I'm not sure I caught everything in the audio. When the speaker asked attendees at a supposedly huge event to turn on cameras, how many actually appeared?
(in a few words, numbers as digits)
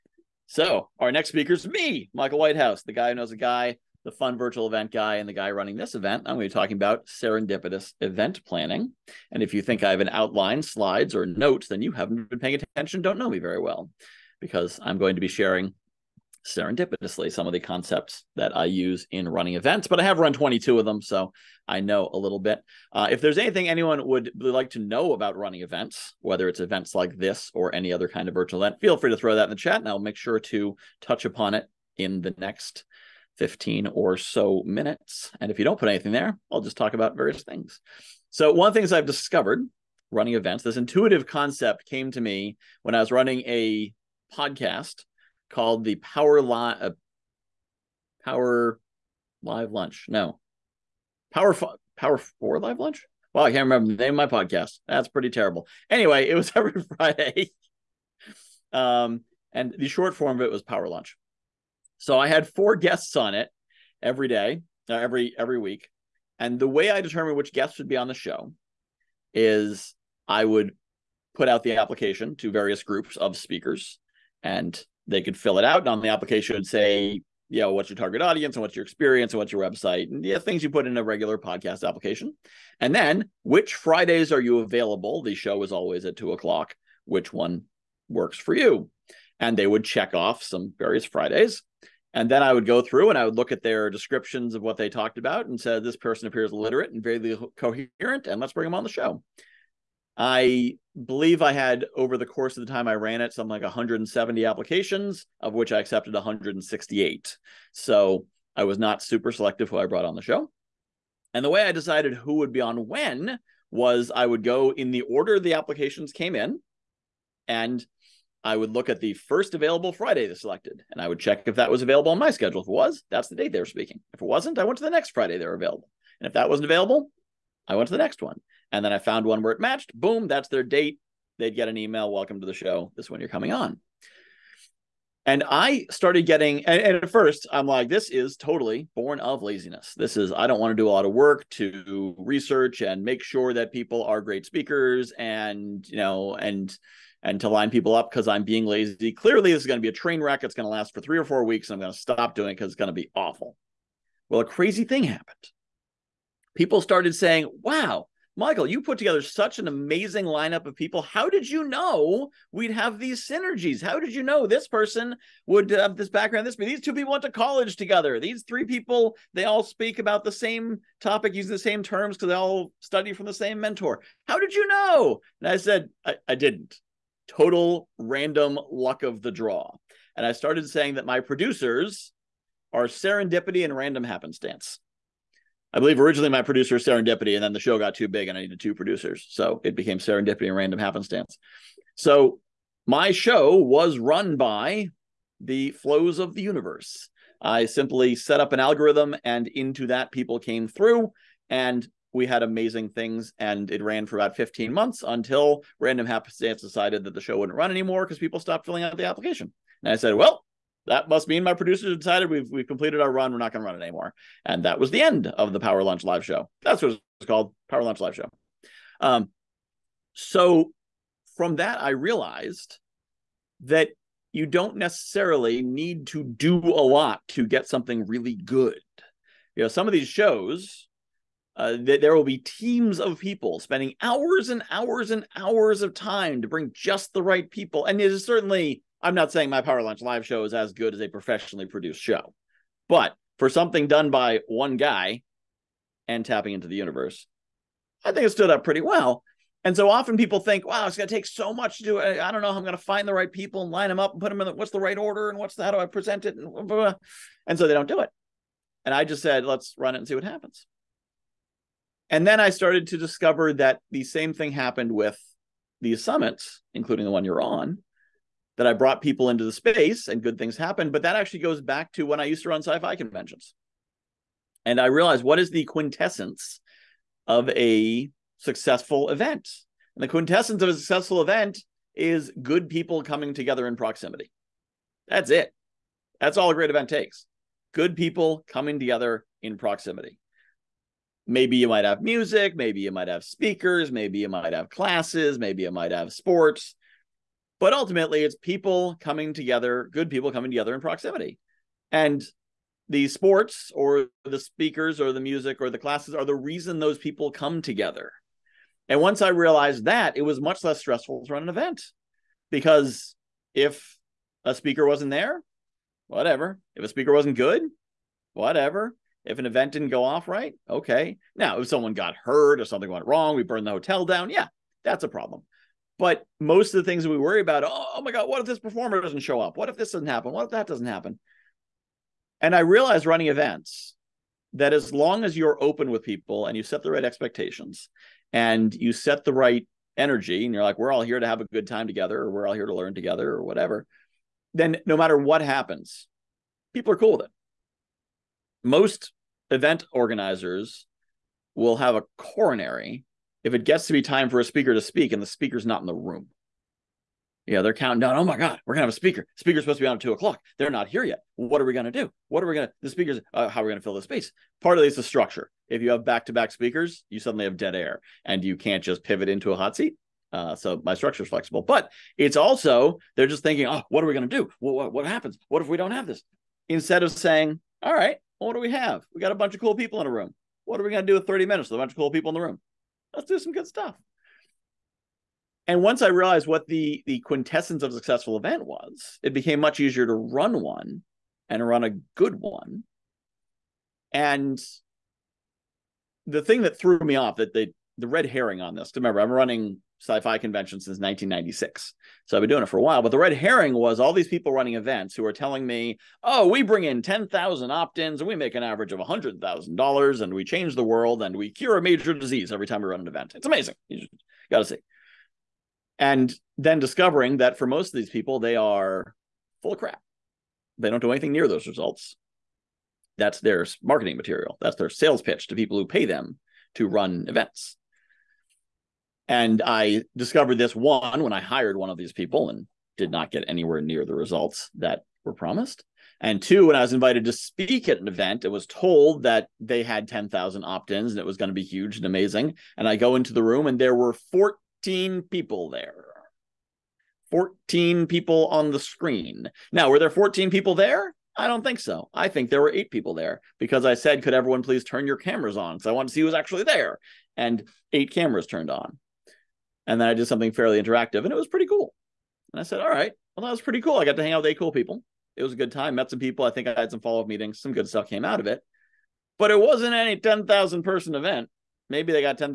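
8.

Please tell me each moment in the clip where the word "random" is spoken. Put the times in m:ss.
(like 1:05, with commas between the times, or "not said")
2:57, 3:03, 3:10, 3:25.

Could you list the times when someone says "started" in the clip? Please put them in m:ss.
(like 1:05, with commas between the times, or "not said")
2:15, 2:36, 3:00, 4:22.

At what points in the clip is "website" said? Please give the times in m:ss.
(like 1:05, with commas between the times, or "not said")
1:19.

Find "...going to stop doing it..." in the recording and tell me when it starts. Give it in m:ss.
2:31.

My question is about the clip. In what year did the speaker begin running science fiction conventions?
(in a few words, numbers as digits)
1996.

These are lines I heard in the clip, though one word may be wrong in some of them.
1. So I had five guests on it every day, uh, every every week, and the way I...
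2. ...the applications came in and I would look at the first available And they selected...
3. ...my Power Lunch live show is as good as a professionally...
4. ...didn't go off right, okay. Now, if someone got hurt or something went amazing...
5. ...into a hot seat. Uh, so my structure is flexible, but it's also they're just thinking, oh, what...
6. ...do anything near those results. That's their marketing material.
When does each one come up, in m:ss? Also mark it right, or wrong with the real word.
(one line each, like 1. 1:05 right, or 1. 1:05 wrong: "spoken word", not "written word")
1. 1:01 wrong: "four", not "five"
2. 1:55 wrong: "Friday", not "And"
3. 3:59 right
4. 5:19 wrong: "wrong", not "amazing"
5. 6:09 right
6. 7:01 right.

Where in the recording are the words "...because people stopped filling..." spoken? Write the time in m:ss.
3:28.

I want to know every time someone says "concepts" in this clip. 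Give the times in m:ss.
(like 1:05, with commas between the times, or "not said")
0:17, 0:41.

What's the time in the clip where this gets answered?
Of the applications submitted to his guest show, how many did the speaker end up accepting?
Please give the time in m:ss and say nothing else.
1:46.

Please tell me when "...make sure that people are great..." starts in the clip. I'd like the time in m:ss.
2:23.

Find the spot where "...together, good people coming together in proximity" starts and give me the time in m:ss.
4:59.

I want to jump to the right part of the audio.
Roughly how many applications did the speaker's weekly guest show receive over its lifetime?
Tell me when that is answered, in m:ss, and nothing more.
1:43.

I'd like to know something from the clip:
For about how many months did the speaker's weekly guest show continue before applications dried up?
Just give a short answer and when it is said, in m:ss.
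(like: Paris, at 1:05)
15 months, at 3:24.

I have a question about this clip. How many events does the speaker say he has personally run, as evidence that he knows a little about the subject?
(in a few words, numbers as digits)
22.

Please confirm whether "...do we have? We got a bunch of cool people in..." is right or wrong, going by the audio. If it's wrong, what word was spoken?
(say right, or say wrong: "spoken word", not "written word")
right.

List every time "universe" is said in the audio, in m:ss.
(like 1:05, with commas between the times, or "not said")
3:16, 4:06.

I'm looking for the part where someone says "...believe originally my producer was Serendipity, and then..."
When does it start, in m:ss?
3:05.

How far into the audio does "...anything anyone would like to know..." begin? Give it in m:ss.
0:23.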